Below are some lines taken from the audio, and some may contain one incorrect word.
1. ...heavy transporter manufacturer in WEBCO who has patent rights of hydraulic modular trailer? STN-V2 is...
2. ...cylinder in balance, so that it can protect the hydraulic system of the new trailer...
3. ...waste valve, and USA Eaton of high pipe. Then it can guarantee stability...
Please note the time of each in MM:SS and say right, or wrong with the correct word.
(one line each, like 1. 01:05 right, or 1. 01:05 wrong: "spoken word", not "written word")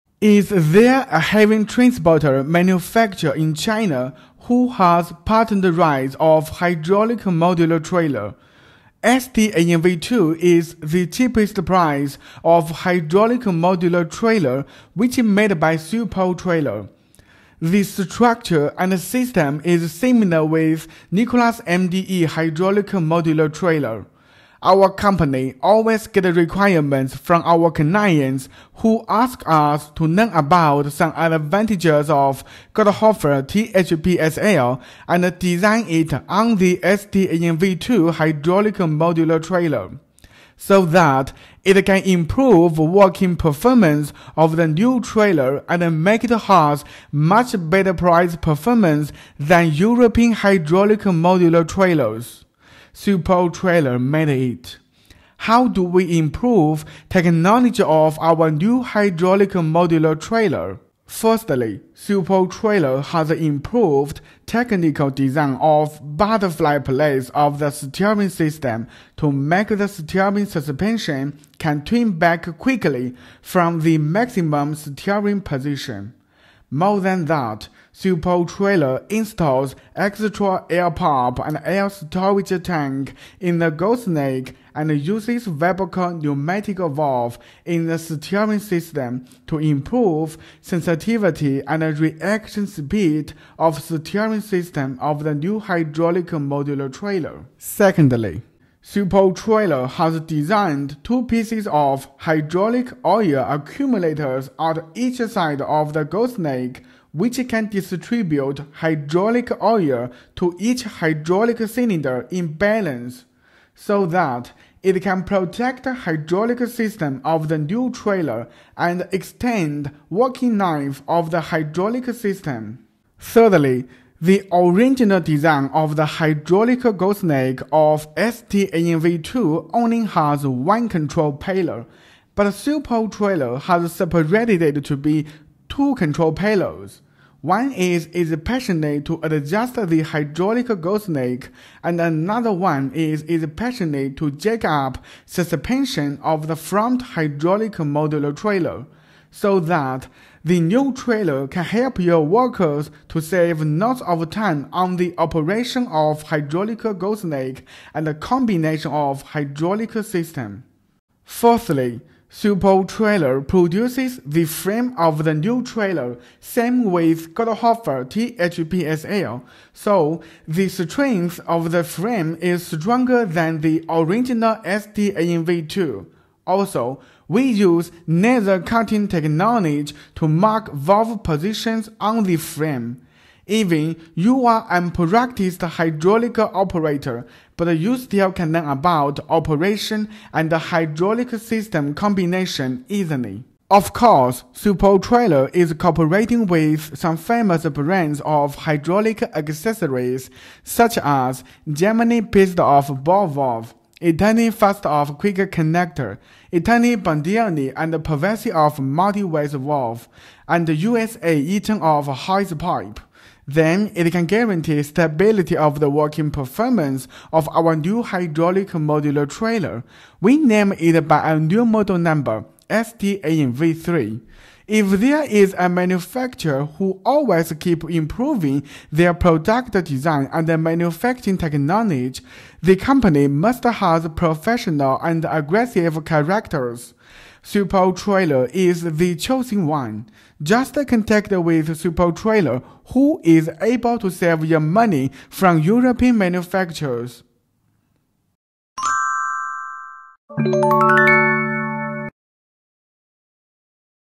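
1. 00:01 wrong: "China", not "WEBCO"
2. 01:51 right
3. 03:29 right.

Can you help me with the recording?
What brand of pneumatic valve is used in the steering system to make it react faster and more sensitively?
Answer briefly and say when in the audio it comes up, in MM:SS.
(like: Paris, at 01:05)
WEBCO, at 01:25.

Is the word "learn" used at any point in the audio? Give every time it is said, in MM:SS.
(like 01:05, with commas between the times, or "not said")
00:30, 03:08.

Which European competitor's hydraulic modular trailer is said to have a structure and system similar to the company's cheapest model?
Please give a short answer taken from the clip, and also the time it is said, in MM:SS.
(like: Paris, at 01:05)
Nicolas MDE, at 00:21.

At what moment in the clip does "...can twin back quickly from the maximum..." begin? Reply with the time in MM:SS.
01:11.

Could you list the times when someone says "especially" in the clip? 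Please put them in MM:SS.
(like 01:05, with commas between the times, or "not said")
02:18, 02:23.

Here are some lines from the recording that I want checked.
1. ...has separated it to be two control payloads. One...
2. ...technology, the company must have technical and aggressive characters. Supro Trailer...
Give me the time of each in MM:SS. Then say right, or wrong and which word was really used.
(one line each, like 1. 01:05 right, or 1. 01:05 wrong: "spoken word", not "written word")
1. 02:13 right
2. 03:51 wrong: "professional", not "technical".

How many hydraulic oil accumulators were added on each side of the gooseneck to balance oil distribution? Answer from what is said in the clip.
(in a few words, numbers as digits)
2.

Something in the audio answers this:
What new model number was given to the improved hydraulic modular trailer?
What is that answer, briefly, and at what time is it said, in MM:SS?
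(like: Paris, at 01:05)
STN-V3, at 03:42.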